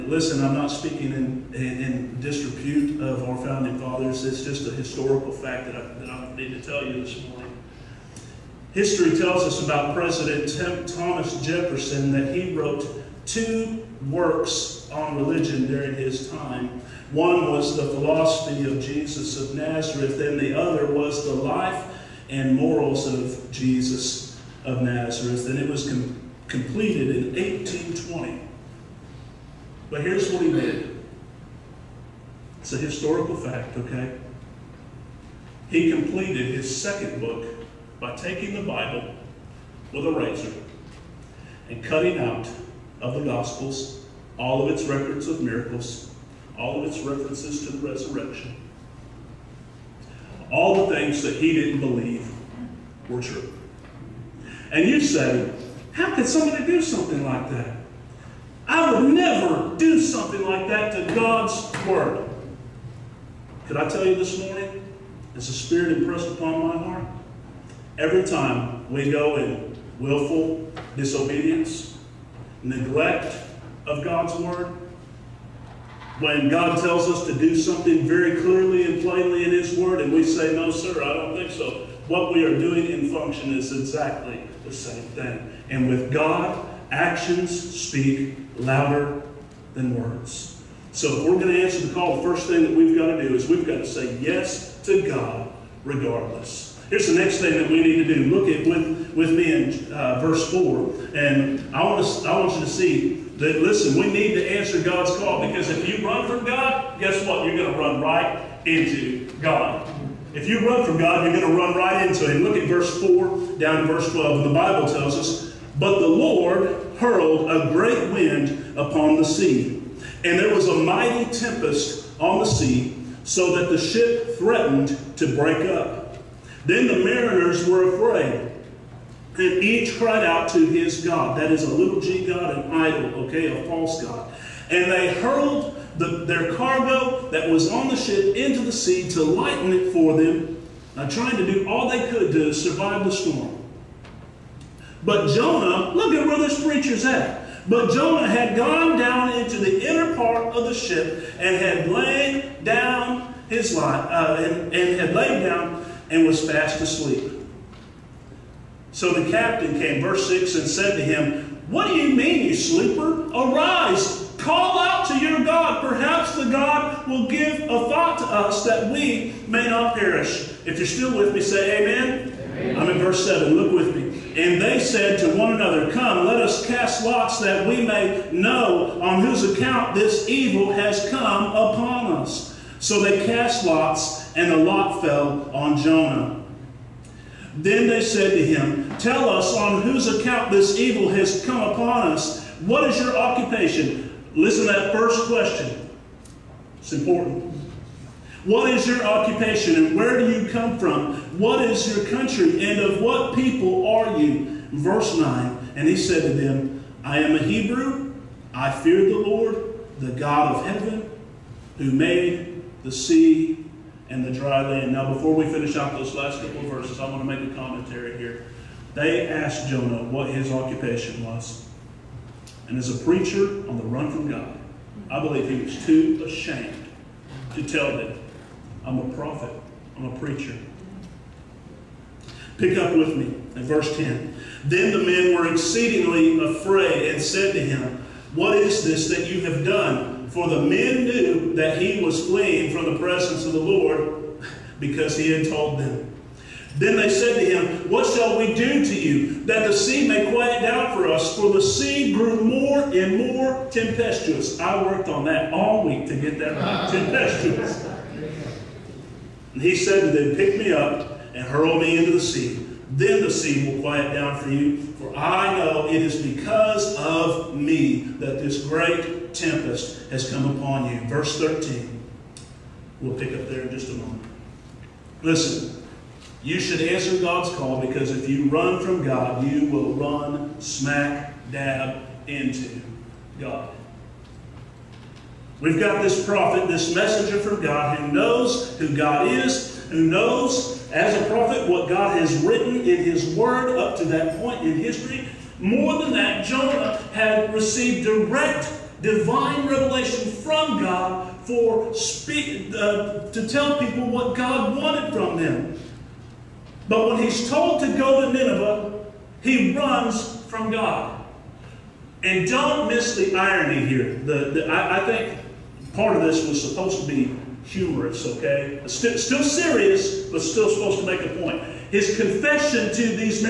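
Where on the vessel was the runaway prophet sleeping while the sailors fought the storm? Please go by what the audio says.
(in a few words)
The inner part of the ship.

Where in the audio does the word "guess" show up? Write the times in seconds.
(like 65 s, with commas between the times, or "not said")
106 s.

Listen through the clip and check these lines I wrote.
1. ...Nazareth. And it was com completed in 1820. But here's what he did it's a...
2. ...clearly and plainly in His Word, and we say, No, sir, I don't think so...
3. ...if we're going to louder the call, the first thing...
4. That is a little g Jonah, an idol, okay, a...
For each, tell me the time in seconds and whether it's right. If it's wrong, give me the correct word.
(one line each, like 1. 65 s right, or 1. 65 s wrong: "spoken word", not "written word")
1. 24 s right
2. 78 s right
3. 91 s wrong: "answer", not "louder"
4. 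131 s wrong: "God", not "Jonah".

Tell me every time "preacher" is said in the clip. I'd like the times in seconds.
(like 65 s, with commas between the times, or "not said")
146 s, 223 s, 230 s.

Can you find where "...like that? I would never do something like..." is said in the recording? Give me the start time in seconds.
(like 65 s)
57 s.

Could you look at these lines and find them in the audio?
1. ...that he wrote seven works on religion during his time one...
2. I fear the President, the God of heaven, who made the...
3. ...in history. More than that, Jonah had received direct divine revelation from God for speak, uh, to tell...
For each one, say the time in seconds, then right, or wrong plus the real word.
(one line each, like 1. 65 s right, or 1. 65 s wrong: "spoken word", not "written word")
1. 12 s wrong: "two", not "seven"
2. 208 s wrong: "Lord", not "President"
3. 294 s right.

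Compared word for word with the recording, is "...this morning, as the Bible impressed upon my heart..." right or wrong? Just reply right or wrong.
wrong.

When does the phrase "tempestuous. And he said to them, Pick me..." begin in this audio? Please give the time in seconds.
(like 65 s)
256 s.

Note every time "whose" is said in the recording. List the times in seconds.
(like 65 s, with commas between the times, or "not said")
179 s, 189 s.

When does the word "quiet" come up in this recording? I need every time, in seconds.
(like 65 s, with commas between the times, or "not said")
250 s, 263 s.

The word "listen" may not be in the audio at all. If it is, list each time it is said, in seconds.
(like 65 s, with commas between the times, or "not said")
0 s, 103 s, 194 s, 275 s.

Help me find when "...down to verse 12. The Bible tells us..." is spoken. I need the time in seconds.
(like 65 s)
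113 s.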